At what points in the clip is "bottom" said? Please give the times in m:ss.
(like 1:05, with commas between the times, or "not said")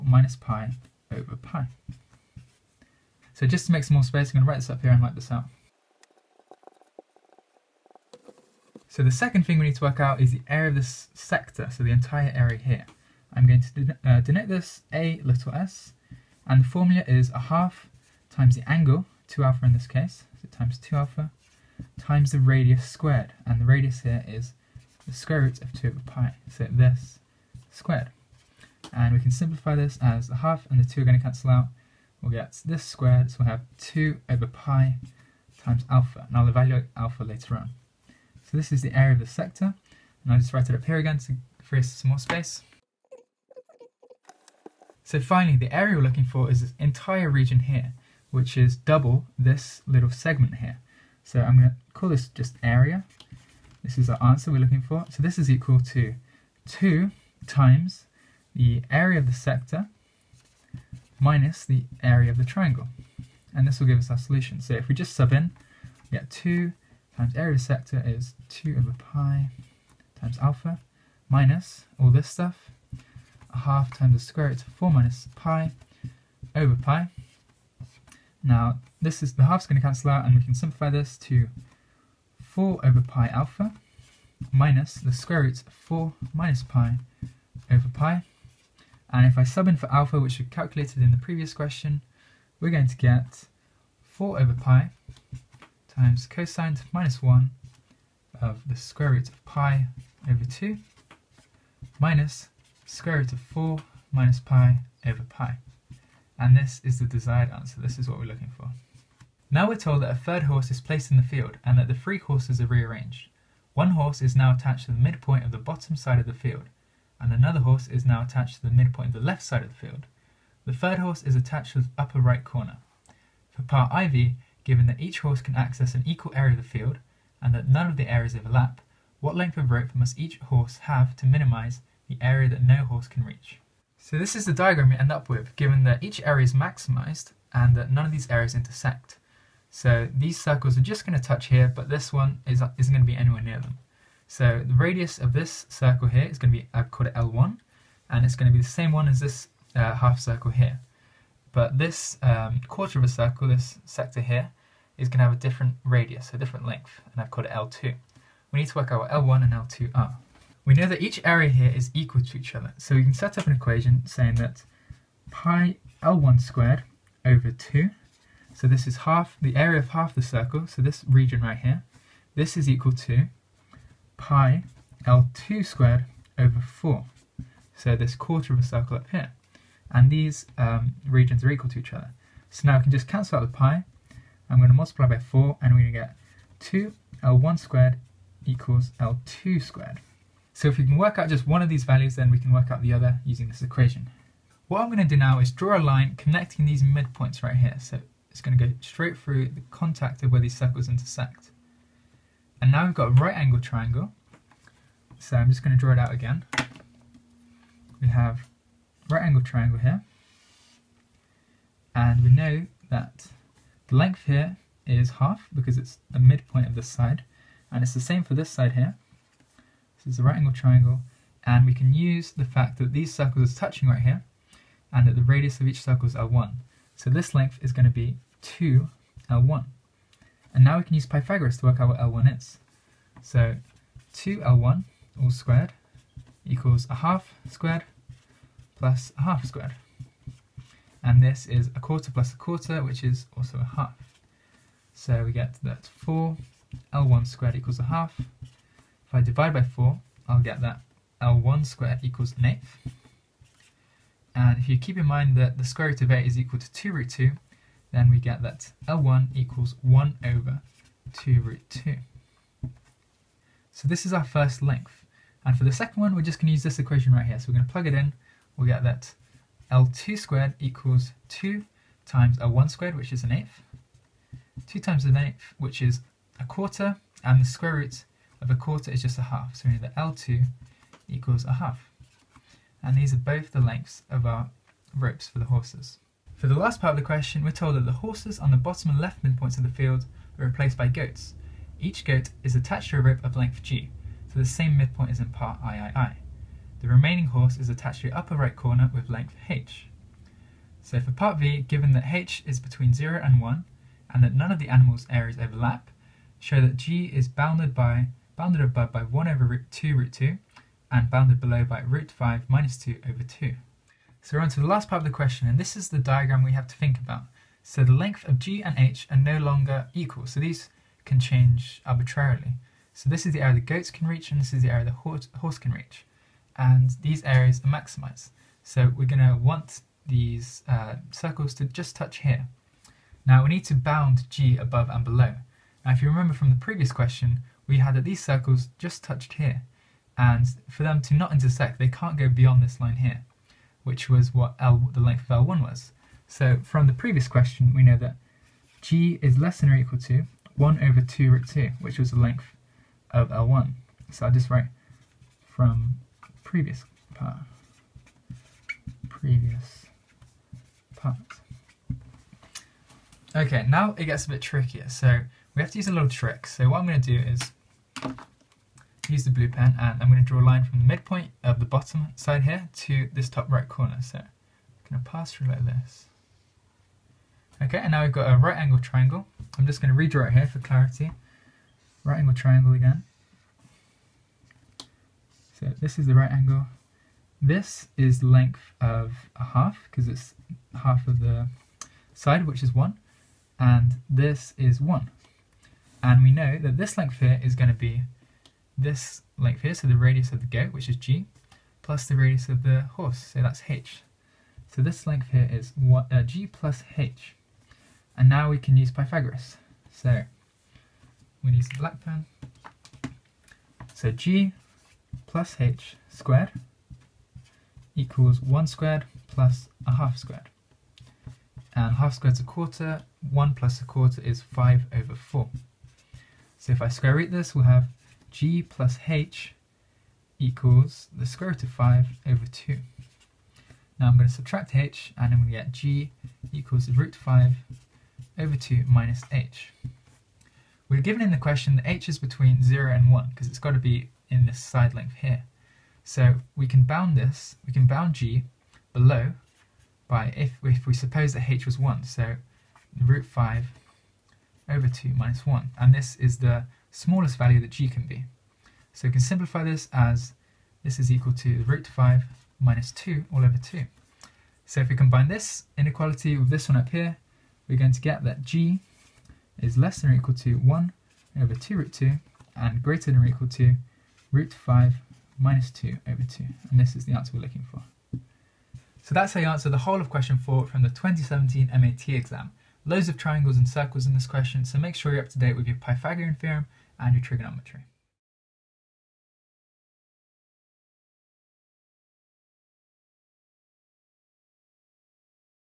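1:55, 4:48, 6:11.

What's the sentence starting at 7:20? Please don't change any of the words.
We're given in the question that h is between 0 and 1 because it's got to be in this side length here.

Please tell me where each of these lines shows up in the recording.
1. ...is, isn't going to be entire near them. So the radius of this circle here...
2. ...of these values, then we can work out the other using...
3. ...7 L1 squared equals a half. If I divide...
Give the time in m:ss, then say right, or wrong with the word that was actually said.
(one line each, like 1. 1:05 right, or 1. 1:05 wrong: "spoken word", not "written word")
1. 2:22 wrong: "anywhere", not "entire"
2. 3:11 right
3. 4:05 wrong: "4", not "7".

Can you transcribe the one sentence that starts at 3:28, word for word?
We have right angle triangle here.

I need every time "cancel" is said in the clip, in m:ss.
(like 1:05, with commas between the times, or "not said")
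0:31, 1:19, 3:03.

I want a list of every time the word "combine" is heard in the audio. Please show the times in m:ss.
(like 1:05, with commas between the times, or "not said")
7:44.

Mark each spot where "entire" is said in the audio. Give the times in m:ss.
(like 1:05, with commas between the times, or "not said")
0:11, 0:46.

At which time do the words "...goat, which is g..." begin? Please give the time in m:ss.
6:40.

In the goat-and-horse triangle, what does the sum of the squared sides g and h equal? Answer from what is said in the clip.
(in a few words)
5/4.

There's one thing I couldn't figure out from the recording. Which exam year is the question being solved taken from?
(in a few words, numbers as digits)
2017.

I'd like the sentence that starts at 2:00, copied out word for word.
The third horse is attached to the upper right corner.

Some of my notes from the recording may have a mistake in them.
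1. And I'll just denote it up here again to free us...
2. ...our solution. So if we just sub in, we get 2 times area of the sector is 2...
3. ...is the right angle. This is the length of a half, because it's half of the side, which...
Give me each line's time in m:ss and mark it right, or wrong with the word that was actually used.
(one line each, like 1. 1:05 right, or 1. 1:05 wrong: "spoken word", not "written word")
1. 0:40 wrong: "write", not "denote"
2. 1:04 right
3. 6:25 right.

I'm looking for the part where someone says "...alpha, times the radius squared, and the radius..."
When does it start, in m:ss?
0:20.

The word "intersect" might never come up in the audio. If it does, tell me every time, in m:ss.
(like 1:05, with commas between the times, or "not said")
2:18, 3:20, 5:41.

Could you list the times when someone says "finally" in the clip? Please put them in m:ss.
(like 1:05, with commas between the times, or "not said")
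0:45.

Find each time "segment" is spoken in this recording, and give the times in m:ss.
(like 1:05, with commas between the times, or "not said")
0:50.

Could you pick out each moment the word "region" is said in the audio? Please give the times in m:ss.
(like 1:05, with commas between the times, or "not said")
0:47, 2:51, 3:01.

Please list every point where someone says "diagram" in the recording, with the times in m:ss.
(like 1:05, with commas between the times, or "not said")
2:14, 5:15.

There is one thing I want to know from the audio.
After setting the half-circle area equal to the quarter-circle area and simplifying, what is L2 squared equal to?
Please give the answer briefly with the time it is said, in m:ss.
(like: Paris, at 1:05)
2 L1 squared, at 3:06.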